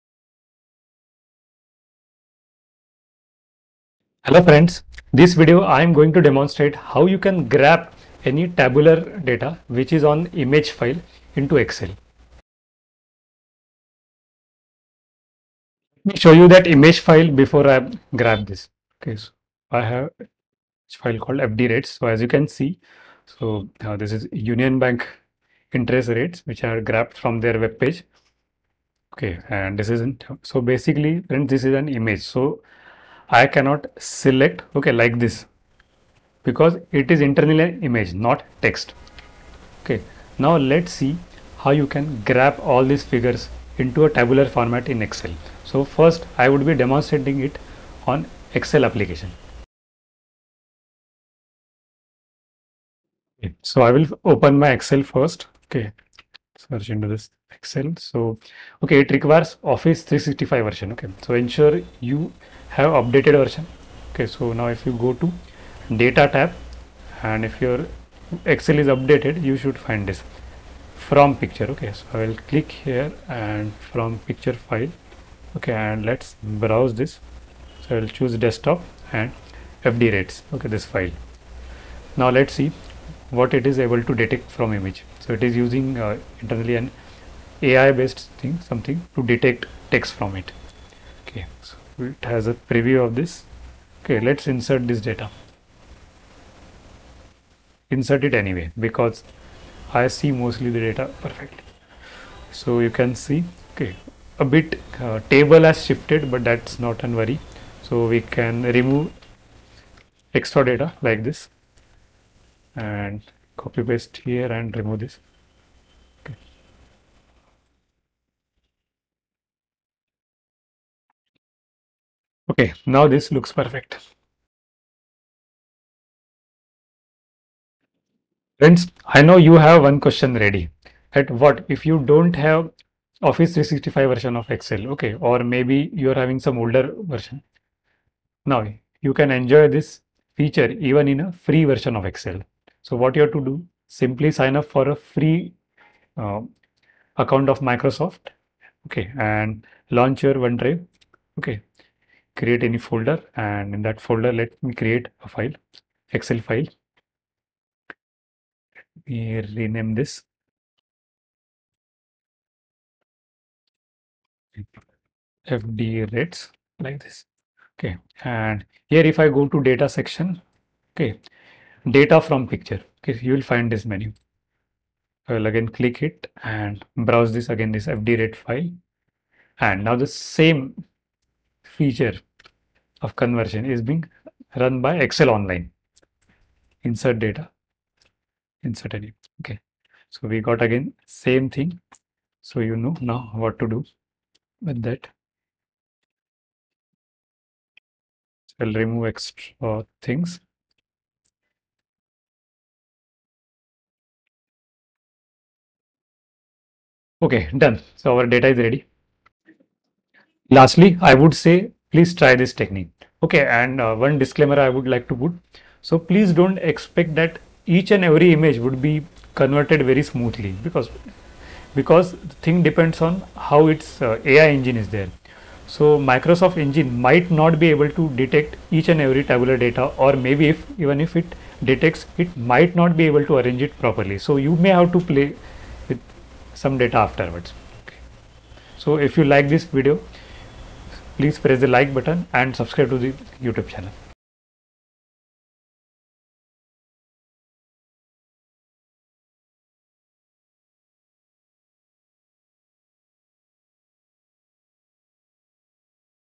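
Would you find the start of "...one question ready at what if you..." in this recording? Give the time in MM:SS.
02:09.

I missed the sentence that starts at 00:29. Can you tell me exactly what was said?
Okay, and this isn't so basically, friends, this is an image.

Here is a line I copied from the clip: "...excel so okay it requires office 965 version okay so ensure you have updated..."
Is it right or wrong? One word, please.
wrong.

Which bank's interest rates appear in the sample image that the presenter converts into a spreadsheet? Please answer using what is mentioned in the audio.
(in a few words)
Union Bank.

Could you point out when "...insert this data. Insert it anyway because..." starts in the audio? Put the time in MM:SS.
01:34.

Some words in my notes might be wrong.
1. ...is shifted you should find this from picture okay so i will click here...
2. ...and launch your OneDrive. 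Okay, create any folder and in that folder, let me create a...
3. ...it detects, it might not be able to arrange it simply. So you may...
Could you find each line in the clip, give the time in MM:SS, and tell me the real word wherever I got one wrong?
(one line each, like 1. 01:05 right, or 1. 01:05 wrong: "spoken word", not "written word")
1. 01:08 wrong: "updated", not "shifted"
2. 02:29 right
3. 03:51 wrong: "properly", not "simply".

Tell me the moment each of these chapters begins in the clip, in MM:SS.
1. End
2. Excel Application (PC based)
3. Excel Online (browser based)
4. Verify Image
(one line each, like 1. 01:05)
1. 03:29
2. 00:50
3. 02:04
4. 00:15.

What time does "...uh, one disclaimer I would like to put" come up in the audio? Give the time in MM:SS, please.
03:33.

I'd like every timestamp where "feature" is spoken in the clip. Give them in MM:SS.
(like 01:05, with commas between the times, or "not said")
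02:20, 03:01.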